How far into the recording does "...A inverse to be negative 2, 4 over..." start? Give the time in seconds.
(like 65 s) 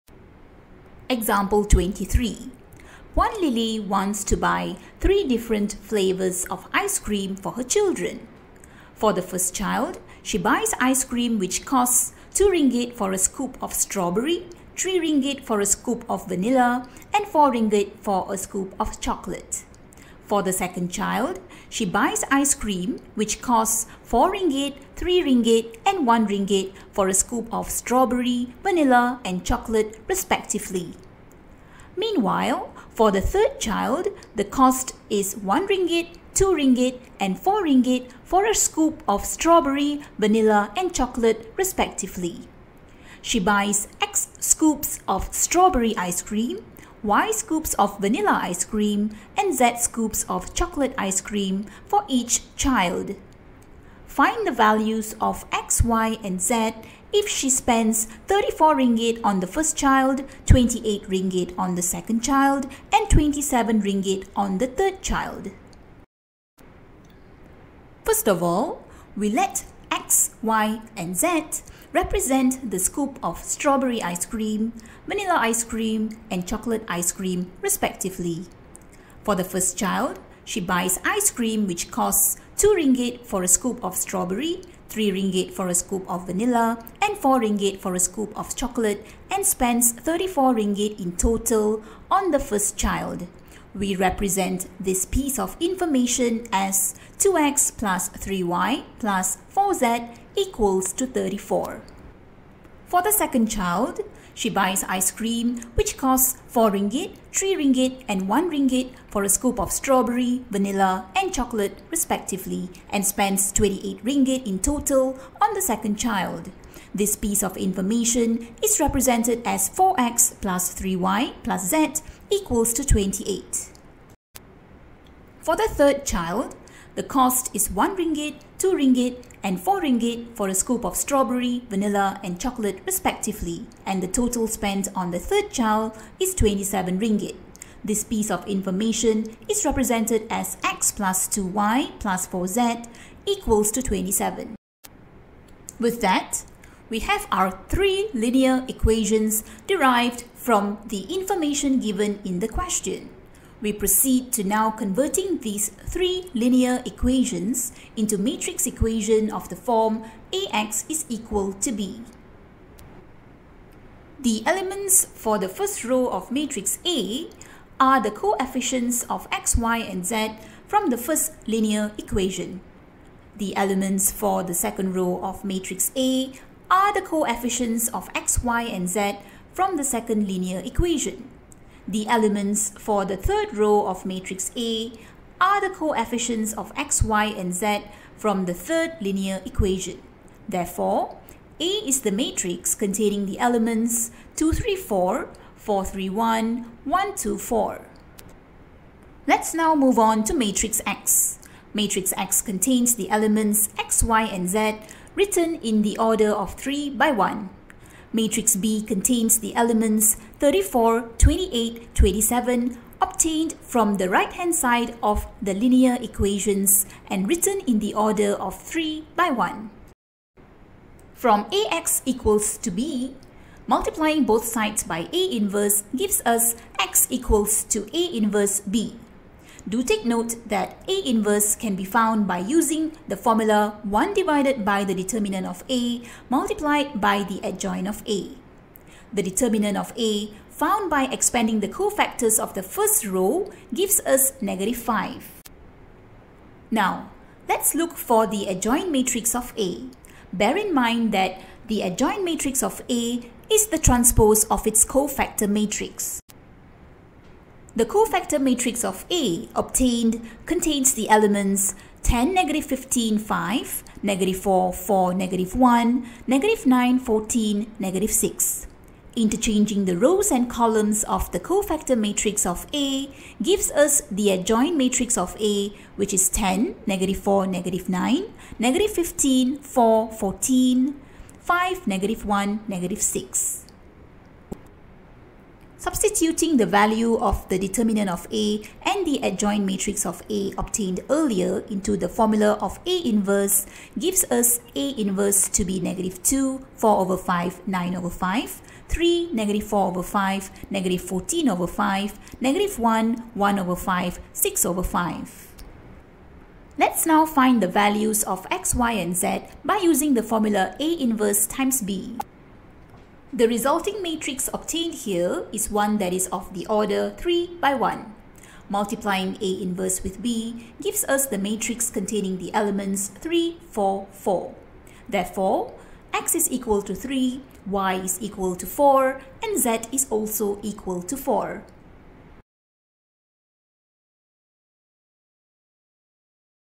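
294 s.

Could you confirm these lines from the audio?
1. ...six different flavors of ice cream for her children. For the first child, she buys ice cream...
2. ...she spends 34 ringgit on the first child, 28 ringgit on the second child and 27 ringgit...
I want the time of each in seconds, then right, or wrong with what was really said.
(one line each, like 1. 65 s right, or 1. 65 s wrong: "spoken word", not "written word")
1. 5 s wrong: "three", not "six"
2. 57 s right.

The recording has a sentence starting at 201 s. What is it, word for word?
Matrix X contains the elements x, y and z written in the order of 3 by 1.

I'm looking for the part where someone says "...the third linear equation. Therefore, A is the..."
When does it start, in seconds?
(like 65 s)
188 s.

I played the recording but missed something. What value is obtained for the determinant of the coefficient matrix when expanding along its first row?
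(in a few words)
-5.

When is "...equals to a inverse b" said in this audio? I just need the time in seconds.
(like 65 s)
227 s.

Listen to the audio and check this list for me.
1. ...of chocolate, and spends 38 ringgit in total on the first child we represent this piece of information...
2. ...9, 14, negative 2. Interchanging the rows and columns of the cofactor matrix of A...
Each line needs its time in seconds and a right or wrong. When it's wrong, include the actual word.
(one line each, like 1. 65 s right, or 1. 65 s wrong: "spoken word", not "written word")
1. 88 s wrong: "34", not "38"
2. 266 s wrong: "6", not "2".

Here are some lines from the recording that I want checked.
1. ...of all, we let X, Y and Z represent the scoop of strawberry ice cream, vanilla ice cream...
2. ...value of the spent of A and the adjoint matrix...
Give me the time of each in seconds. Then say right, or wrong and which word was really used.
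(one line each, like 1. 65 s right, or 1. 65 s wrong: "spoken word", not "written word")
1. 68 s right
2. 286 s wrong: "determinant", not "spent".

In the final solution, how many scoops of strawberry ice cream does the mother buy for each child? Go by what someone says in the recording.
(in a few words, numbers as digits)
3.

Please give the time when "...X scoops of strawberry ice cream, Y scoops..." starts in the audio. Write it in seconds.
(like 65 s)
43 s.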